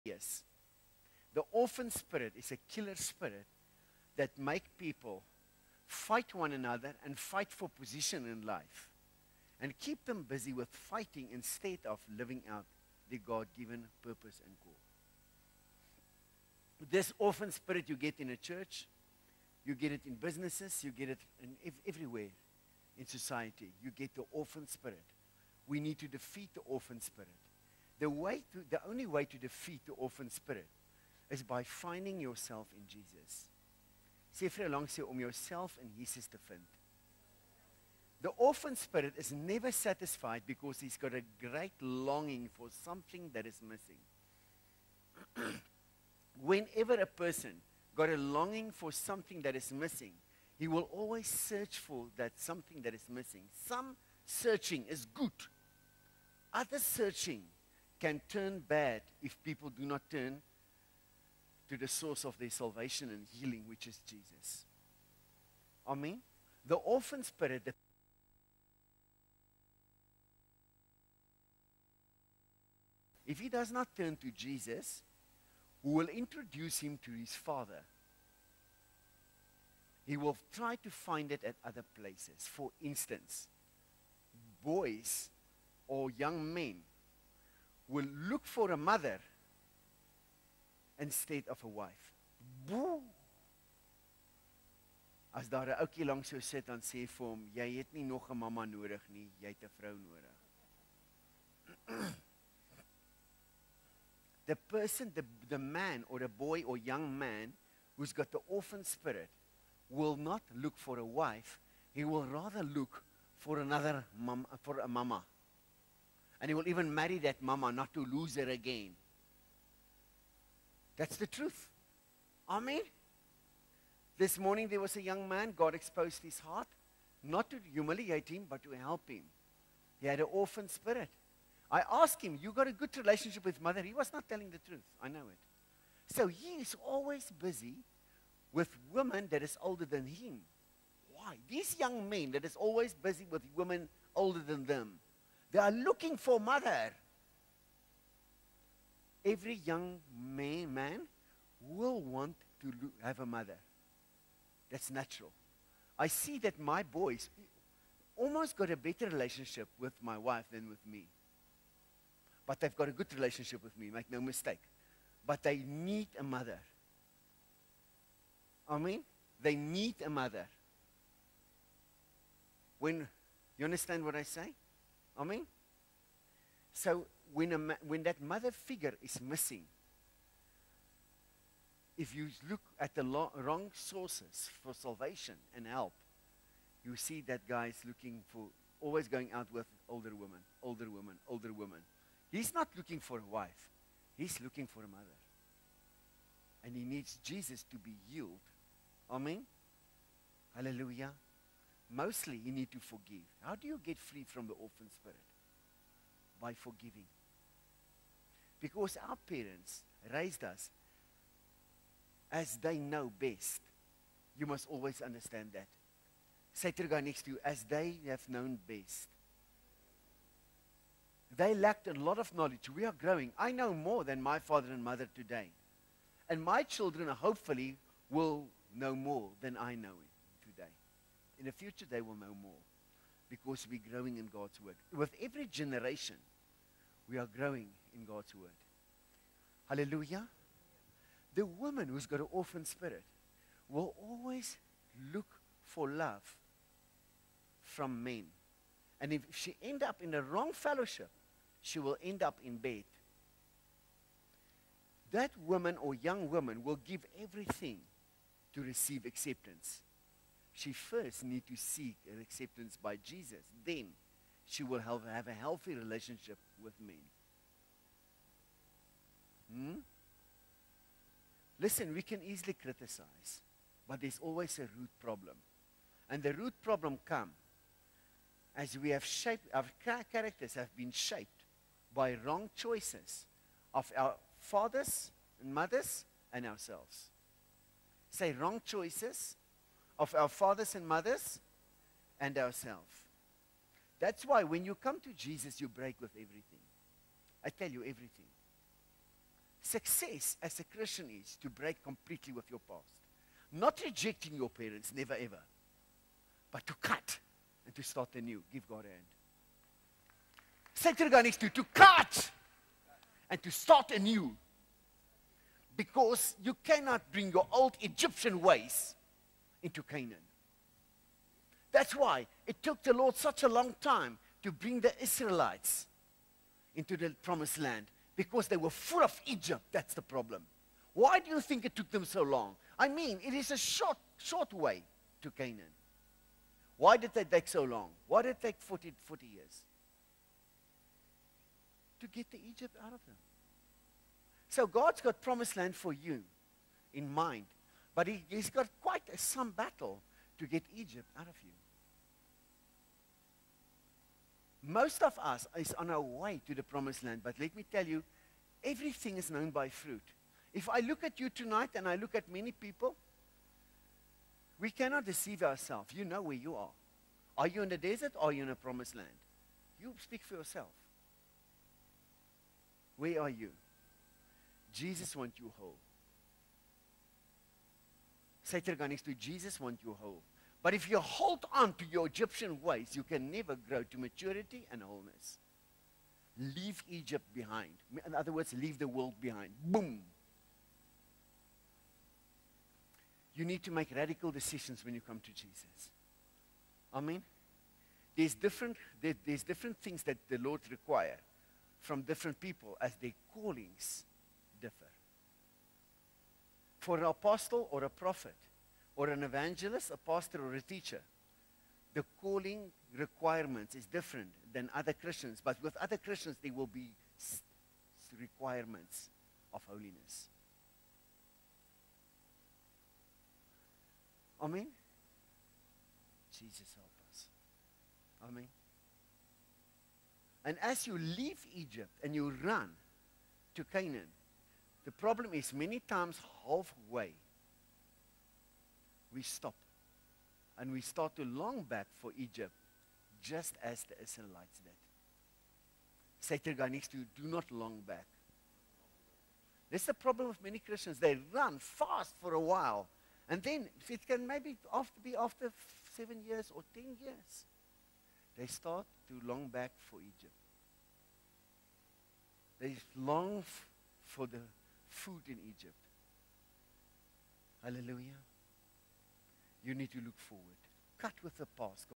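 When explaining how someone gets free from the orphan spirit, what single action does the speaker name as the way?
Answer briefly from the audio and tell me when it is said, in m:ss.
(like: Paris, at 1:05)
Forgiving, at 3:26.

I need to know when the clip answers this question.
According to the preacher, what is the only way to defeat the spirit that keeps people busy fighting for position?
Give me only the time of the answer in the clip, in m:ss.
0:31.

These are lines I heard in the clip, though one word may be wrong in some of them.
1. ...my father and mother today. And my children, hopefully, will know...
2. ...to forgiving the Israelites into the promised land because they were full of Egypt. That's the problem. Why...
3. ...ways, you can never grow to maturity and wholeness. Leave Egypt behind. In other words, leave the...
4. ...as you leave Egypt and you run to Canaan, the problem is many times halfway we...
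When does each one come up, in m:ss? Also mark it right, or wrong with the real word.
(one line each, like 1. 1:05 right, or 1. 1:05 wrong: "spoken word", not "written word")
1. 3:44 right
2. 5:24 wrong: "bring", not "forgiving"
3. 6:22 right
4. 7:10 right.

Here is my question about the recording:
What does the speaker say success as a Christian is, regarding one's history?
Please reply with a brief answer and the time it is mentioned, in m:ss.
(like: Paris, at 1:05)
To break completely with your past, at 5:01.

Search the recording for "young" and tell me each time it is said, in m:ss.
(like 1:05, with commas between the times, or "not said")
1:26, 1:46, 2:05, 2:21, 2:29, 4:15.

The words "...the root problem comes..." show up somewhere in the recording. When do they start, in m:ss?
4:36.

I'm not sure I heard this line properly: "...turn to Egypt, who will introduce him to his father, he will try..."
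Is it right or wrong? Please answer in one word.
wrong.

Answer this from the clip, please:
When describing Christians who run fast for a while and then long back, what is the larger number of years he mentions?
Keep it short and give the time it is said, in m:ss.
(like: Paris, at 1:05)
10, at 7:36.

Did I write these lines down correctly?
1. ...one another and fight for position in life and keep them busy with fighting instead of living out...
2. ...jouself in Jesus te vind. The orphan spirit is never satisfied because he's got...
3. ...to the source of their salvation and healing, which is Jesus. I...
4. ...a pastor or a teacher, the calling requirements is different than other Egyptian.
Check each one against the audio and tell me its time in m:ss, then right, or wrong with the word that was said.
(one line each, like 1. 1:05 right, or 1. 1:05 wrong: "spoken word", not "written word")
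1. 0:06 right
2. 0:35 right
3. 1:01 right
4. 6:49 wrong: "Christians", not "Egyptian".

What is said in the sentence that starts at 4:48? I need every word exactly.
Say wrong choices of our fathers and mothers and ourselves.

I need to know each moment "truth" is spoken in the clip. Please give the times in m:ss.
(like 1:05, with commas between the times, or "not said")
2:01, 2:14.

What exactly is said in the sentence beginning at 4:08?
And if she end up in the wrong fellowship, she will end up in bed.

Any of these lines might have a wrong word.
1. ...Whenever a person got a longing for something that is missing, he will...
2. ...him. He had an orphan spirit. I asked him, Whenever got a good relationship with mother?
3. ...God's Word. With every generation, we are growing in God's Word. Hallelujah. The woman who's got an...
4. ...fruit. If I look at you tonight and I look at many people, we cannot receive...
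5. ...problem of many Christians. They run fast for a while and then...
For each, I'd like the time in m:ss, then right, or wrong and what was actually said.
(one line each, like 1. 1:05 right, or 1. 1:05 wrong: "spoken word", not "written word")
1. 0:46 right
2. 2:09 wrong: "You", not "Whenever"
3. 3:54 right
4. 5:59 wrong: "deceive", not "receive"
5. 7:29 right.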